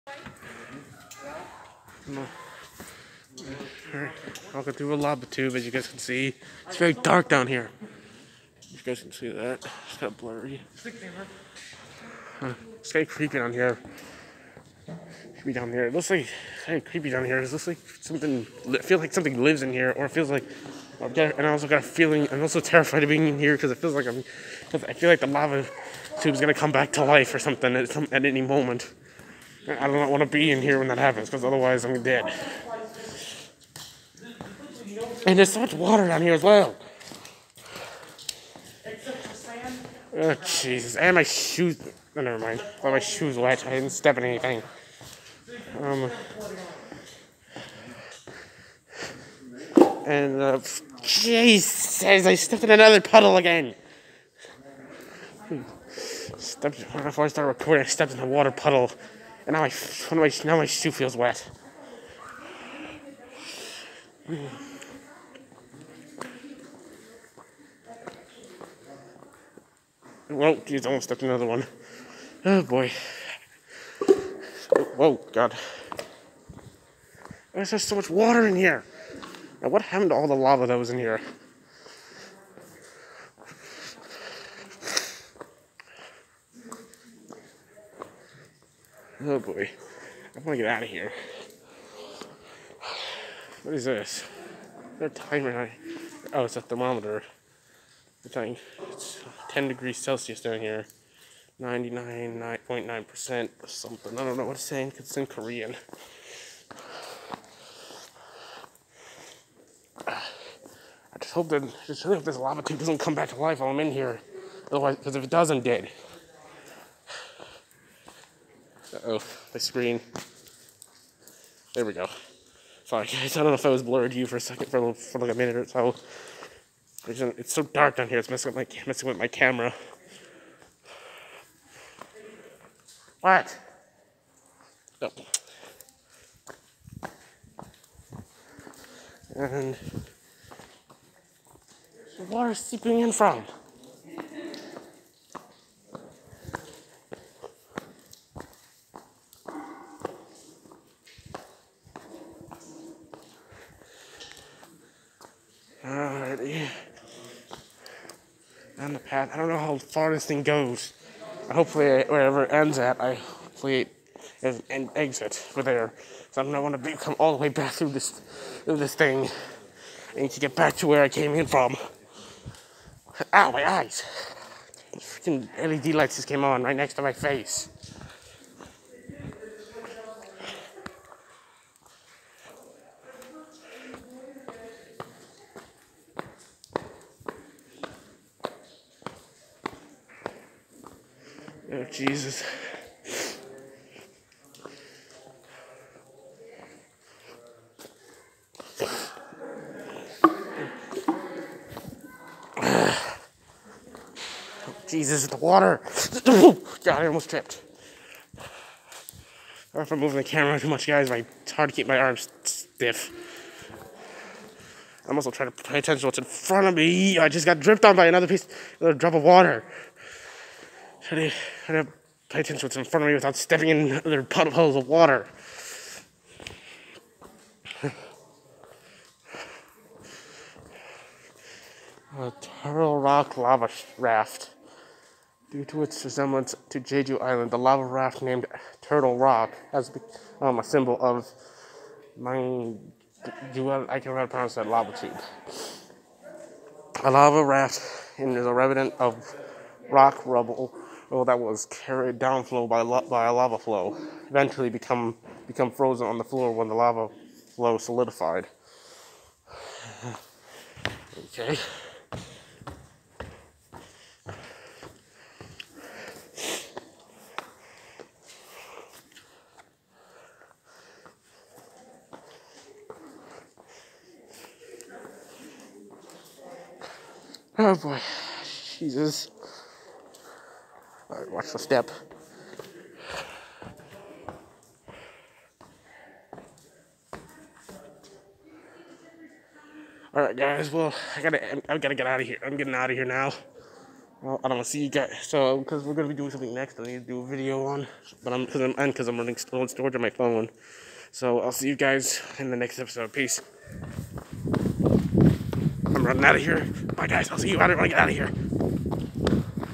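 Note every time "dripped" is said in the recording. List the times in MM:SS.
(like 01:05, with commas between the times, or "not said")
03:37.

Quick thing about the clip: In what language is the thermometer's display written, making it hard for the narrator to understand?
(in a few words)
Korean.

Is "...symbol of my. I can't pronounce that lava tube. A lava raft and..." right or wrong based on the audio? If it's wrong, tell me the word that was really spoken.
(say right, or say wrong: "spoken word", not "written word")
right.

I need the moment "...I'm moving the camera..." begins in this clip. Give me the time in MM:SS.
03:29.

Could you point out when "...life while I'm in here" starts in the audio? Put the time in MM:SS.
01:53.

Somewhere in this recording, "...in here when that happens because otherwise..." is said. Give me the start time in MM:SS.
00:30.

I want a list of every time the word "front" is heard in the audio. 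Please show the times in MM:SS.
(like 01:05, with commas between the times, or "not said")
03:36, 03:42.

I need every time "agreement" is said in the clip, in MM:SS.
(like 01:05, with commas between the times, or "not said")
not said.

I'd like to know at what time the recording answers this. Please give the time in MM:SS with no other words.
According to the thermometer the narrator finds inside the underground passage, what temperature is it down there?
01:39.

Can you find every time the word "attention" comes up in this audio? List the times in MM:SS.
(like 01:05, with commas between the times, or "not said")
03:35, 03:42.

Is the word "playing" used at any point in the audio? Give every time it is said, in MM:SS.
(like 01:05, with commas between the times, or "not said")
not said.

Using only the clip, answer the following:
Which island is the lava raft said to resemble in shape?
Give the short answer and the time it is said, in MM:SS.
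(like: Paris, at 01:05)
Jeju Island, at 03:56.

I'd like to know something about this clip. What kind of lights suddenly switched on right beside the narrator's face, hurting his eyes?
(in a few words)
LED lights.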